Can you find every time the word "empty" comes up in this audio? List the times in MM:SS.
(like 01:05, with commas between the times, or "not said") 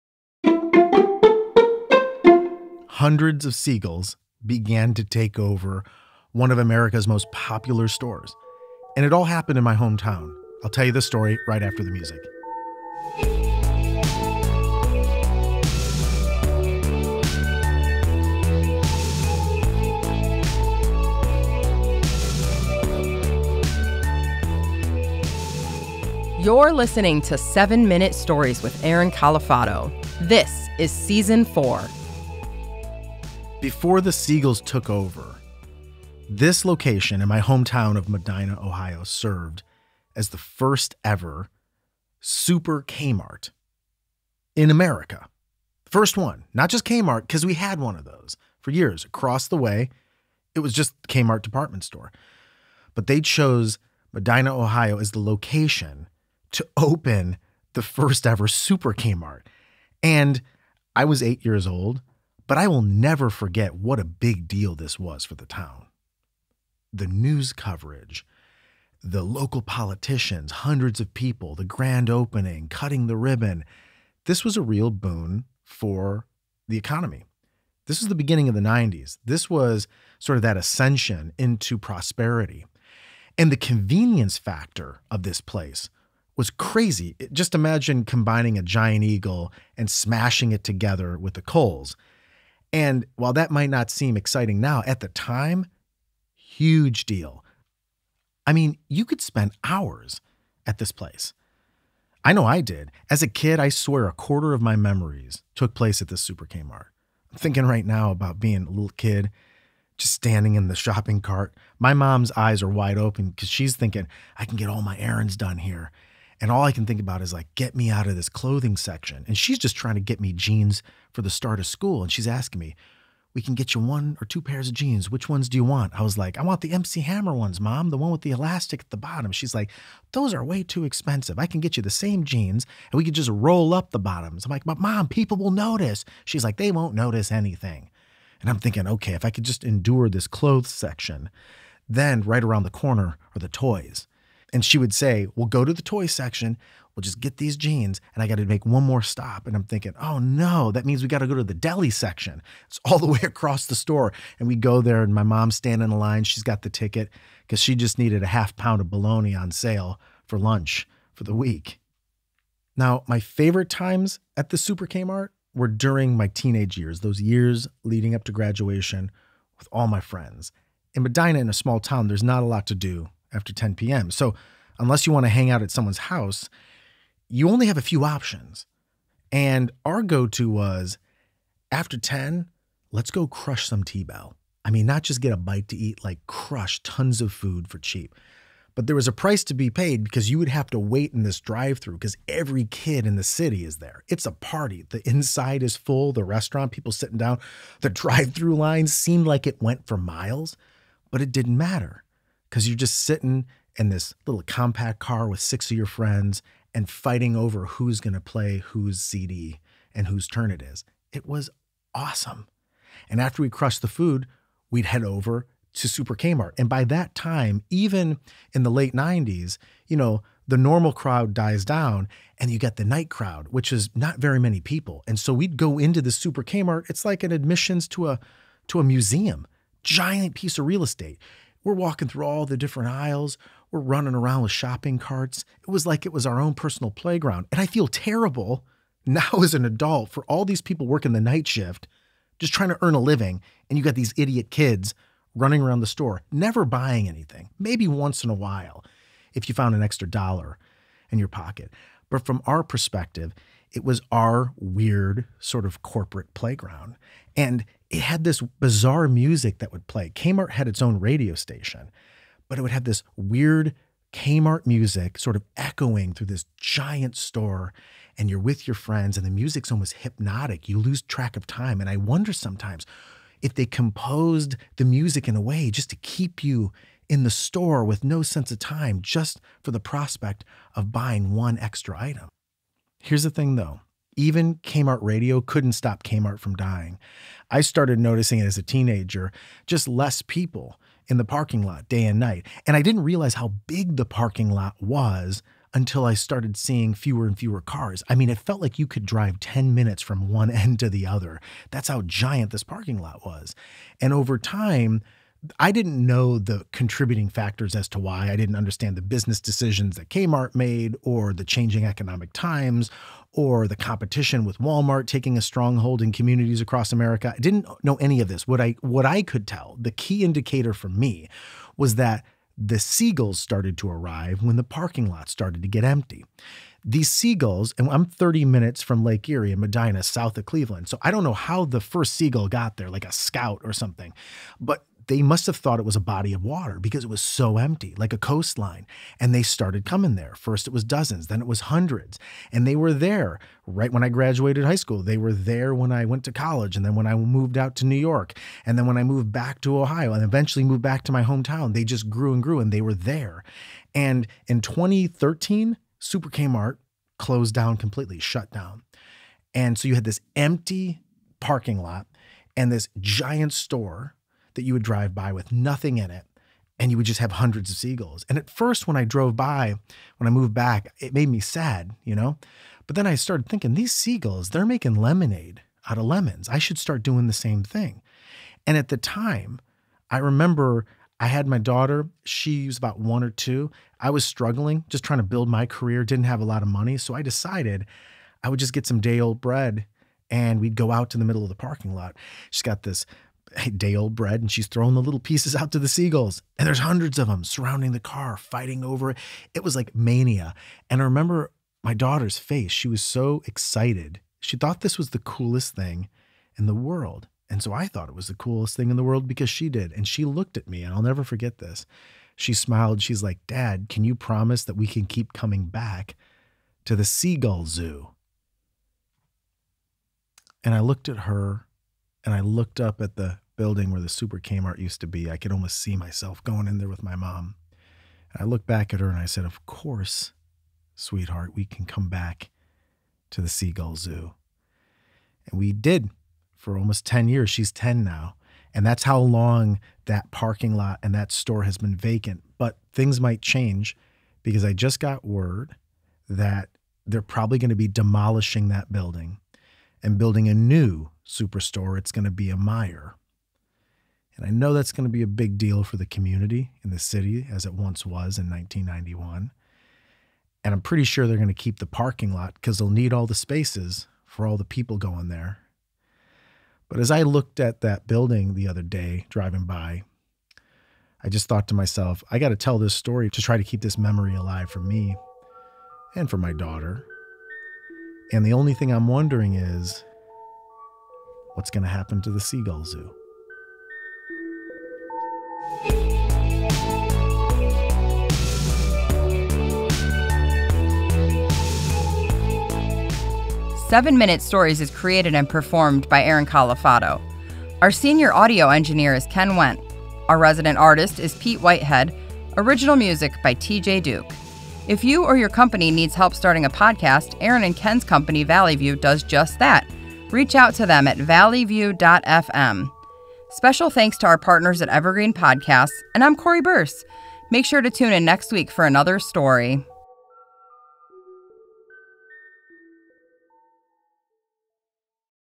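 05:25, 05:37, 06:00.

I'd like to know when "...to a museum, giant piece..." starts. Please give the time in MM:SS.
03:48.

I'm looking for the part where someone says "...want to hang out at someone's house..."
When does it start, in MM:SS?
02:55.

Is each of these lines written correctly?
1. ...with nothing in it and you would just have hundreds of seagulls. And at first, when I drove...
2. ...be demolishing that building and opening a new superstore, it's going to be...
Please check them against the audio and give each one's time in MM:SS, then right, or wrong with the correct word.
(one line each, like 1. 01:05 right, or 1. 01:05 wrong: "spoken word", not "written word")
1. 06:05 right
2. 07:27 wrong: "building", not "opening".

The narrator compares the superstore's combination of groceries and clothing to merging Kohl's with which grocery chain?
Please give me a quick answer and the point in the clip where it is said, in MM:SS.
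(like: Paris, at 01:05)
Giant Eagle, at 01:28.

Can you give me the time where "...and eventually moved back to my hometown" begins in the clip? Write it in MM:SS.
05:50.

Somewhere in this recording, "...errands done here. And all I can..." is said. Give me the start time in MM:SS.
01:54.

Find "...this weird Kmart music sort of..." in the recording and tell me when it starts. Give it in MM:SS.
04:22.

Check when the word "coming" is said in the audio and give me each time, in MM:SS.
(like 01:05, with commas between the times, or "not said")
05:39, 06:55.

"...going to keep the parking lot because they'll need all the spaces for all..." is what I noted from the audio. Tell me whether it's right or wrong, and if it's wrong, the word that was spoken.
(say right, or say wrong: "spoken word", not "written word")
right.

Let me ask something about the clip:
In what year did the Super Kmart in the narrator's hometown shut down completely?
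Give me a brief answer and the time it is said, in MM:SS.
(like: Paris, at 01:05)
2013, at 05:54.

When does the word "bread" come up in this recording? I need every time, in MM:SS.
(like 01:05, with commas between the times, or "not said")
06:29, 06:34.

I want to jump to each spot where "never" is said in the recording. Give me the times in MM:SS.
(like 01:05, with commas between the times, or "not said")
01:02, 04:06, 06:51.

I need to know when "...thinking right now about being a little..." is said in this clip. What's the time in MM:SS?
01:47.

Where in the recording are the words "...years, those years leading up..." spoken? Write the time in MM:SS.
02:46.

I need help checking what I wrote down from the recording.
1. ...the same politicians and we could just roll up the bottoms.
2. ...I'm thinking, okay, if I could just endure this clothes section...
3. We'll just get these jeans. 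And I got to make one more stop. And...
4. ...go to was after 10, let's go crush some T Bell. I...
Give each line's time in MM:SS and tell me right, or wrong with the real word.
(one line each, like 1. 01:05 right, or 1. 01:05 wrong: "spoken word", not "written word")
1. 02:11 wrong: "jeans", not "politicians"
2. 02:18 right
3. 02:26 right
4. 03:00 right.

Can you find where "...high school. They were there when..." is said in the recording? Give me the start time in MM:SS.
05:44.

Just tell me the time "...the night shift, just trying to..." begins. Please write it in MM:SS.
04:01.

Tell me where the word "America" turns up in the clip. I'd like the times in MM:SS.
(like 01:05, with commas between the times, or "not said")
00:06, 00:44, 05:16.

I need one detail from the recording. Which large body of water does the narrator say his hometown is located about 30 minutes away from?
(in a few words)
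Lake Erie.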